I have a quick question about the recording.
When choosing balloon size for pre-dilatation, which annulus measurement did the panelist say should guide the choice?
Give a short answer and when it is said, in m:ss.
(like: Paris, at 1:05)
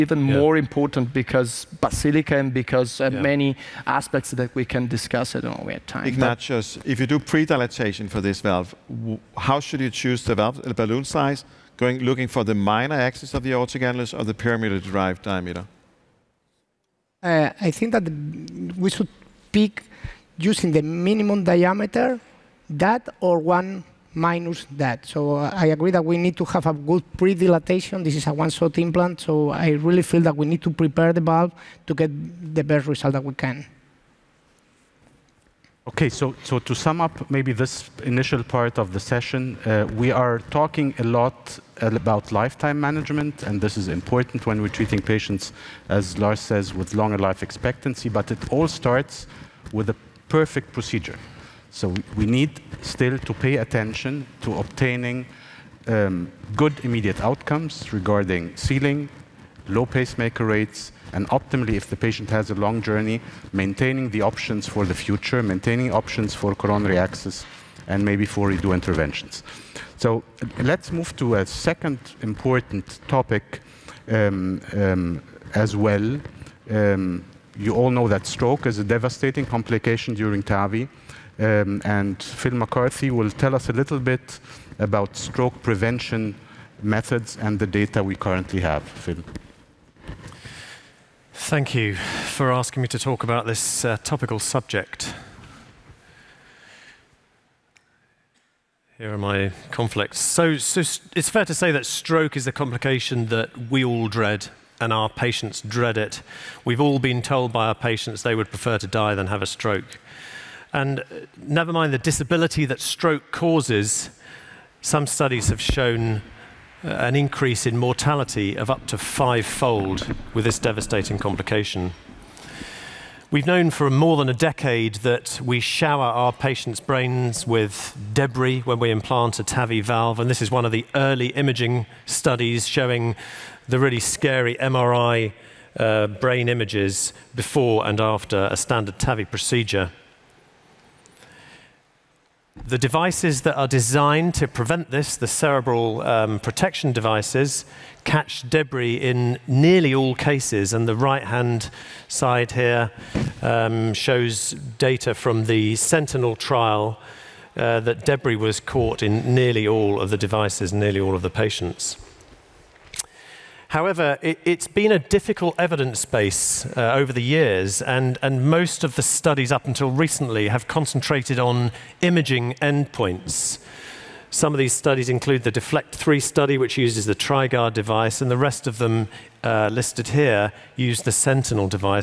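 minimum diameter, at 0:21.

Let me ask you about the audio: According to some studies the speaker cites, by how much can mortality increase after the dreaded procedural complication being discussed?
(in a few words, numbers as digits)
fivefold.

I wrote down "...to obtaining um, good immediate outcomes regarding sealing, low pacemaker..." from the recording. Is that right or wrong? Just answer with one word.
right.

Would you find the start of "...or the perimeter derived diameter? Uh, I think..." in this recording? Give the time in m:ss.
0:14.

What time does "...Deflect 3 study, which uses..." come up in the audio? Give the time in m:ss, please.
2:55.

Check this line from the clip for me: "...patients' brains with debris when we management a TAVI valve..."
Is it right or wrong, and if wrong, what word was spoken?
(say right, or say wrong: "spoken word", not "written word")
wrong: "implant", not "management".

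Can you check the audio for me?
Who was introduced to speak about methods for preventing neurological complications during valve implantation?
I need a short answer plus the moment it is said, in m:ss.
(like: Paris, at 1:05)
Phil MacCarthy, at 1:22.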